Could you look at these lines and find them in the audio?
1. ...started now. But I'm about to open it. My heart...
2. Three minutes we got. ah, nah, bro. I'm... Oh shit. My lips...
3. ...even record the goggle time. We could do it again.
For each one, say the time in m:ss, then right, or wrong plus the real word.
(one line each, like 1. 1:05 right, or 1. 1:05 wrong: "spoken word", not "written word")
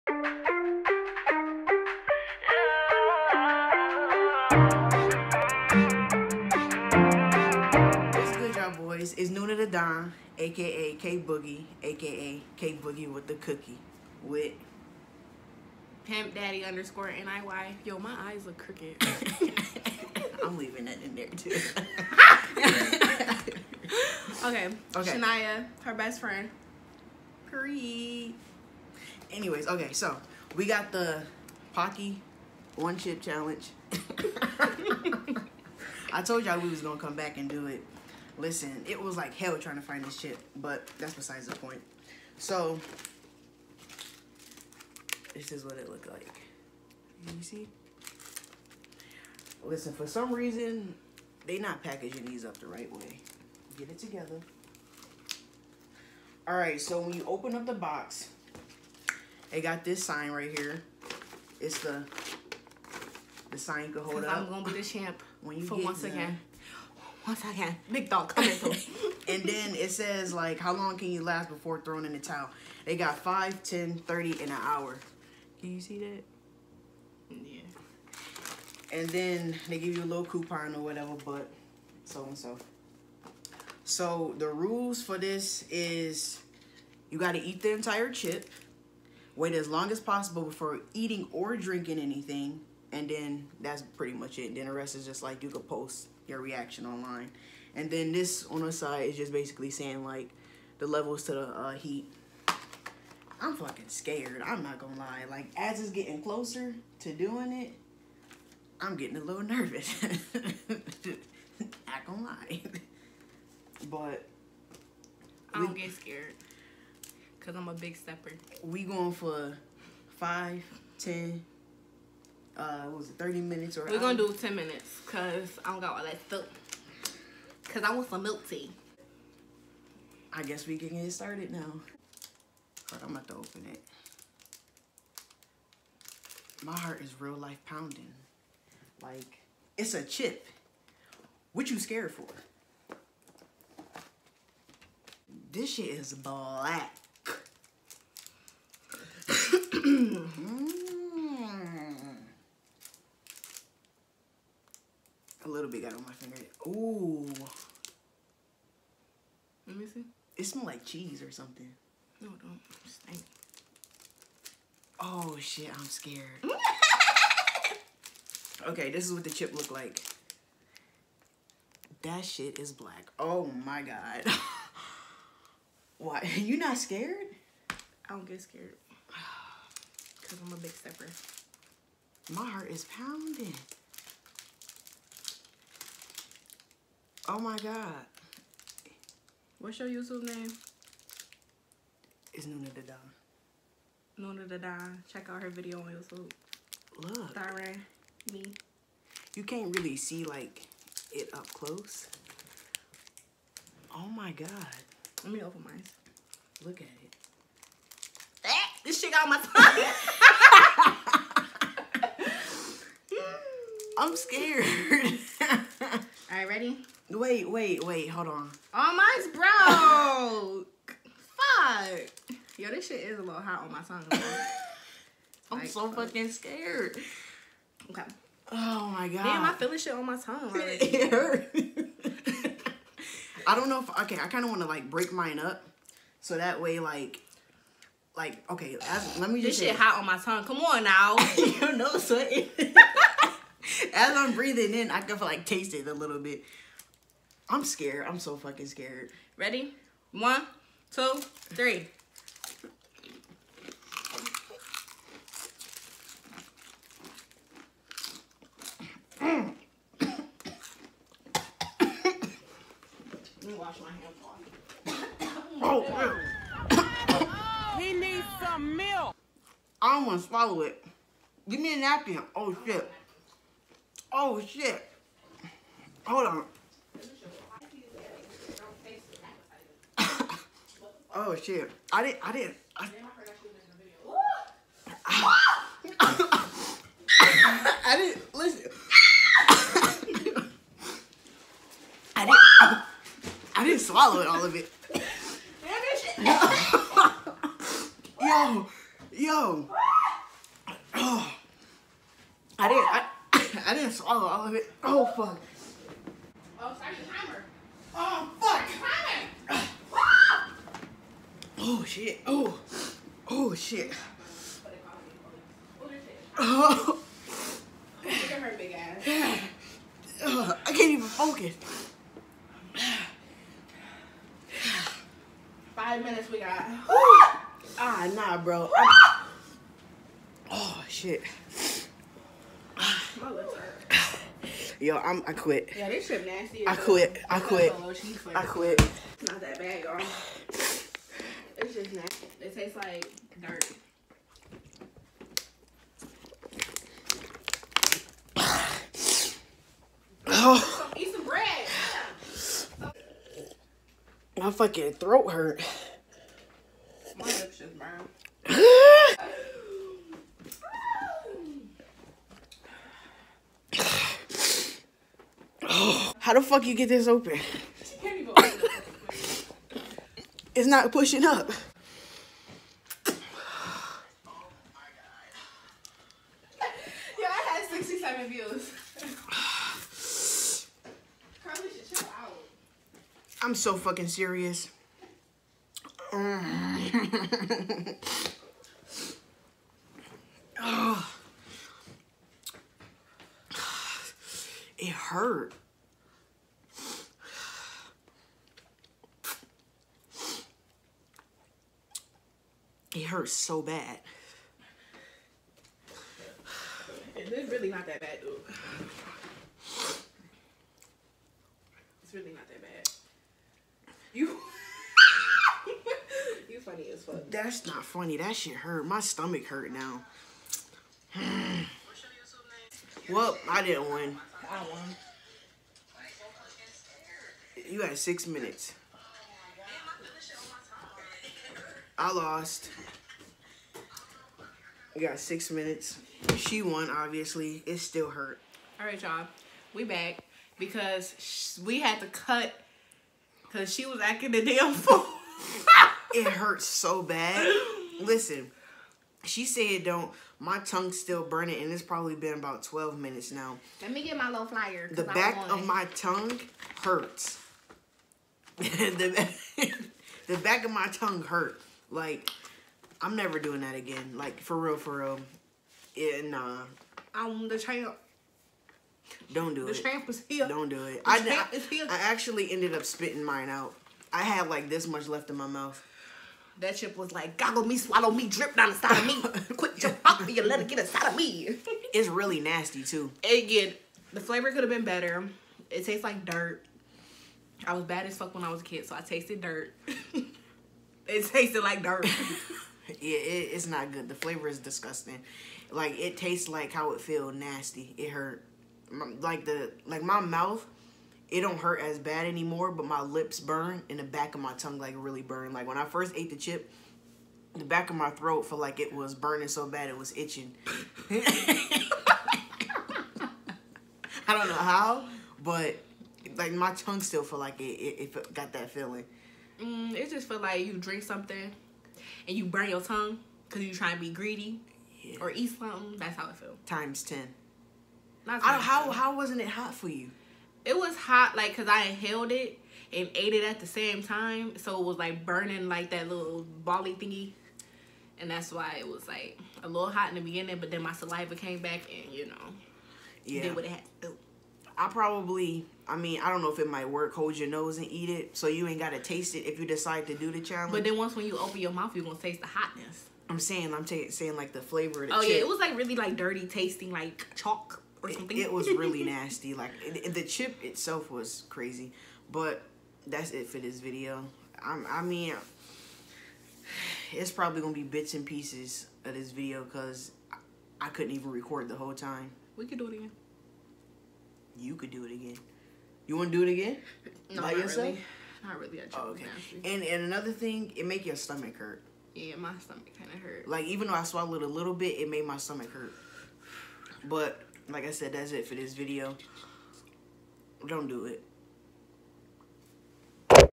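1. 2:11 right
2. 5:25 wrong: "Five", not "Three"
3. 9:31 wrong: "whole", not "goggle".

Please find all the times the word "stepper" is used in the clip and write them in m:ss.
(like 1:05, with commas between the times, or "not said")
1:57, 3:00.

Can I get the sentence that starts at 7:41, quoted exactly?
Like, I'm never doing that again.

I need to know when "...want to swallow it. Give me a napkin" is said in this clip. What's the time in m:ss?
4:30.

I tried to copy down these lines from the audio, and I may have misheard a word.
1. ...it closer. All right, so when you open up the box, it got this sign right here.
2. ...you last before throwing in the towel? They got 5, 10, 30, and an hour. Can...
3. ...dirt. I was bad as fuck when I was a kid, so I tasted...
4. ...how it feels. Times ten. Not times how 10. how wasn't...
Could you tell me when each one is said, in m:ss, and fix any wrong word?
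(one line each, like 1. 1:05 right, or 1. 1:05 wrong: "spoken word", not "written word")
1. 0:53 wrong: "together", not "closer"
2. 1:11 right
3. 8:06 right
4. 8:46 right.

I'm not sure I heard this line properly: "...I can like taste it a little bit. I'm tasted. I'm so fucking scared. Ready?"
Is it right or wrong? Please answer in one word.
wrong.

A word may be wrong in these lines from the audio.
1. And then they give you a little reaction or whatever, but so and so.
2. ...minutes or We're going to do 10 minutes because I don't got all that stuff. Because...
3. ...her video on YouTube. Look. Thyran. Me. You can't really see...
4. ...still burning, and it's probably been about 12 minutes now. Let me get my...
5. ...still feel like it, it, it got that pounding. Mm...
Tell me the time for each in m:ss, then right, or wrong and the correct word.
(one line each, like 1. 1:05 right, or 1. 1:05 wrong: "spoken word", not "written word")
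1. 1:18 wrong: "coupon", not "reaction"
2. 2:03 right
3. 3:15 right
4. 7:30 right
5. 8:37 wrong: "feeling", not "pounding".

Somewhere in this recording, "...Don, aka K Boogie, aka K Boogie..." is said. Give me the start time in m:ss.
0:09.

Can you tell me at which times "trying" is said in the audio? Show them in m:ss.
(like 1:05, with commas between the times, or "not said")
0:39, 8:43.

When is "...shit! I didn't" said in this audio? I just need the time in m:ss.
4:41.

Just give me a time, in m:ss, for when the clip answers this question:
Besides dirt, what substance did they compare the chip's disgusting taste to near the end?
9:17.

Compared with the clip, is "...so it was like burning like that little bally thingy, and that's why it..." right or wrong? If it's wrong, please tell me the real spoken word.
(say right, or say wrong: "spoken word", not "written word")
right.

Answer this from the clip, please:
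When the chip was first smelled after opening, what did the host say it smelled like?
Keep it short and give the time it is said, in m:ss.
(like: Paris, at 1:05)
cheese, at 2:40.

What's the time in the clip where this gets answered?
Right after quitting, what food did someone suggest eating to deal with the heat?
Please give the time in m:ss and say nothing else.
5:51.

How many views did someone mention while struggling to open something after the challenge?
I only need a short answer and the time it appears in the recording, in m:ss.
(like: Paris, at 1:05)
67, at 6:17.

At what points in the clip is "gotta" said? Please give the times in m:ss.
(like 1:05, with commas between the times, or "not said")
1:27, 9:08.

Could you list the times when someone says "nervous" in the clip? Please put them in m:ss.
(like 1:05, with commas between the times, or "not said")
1:49.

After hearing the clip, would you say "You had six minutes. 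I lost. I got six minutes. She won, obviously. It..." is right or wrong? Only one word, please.
right.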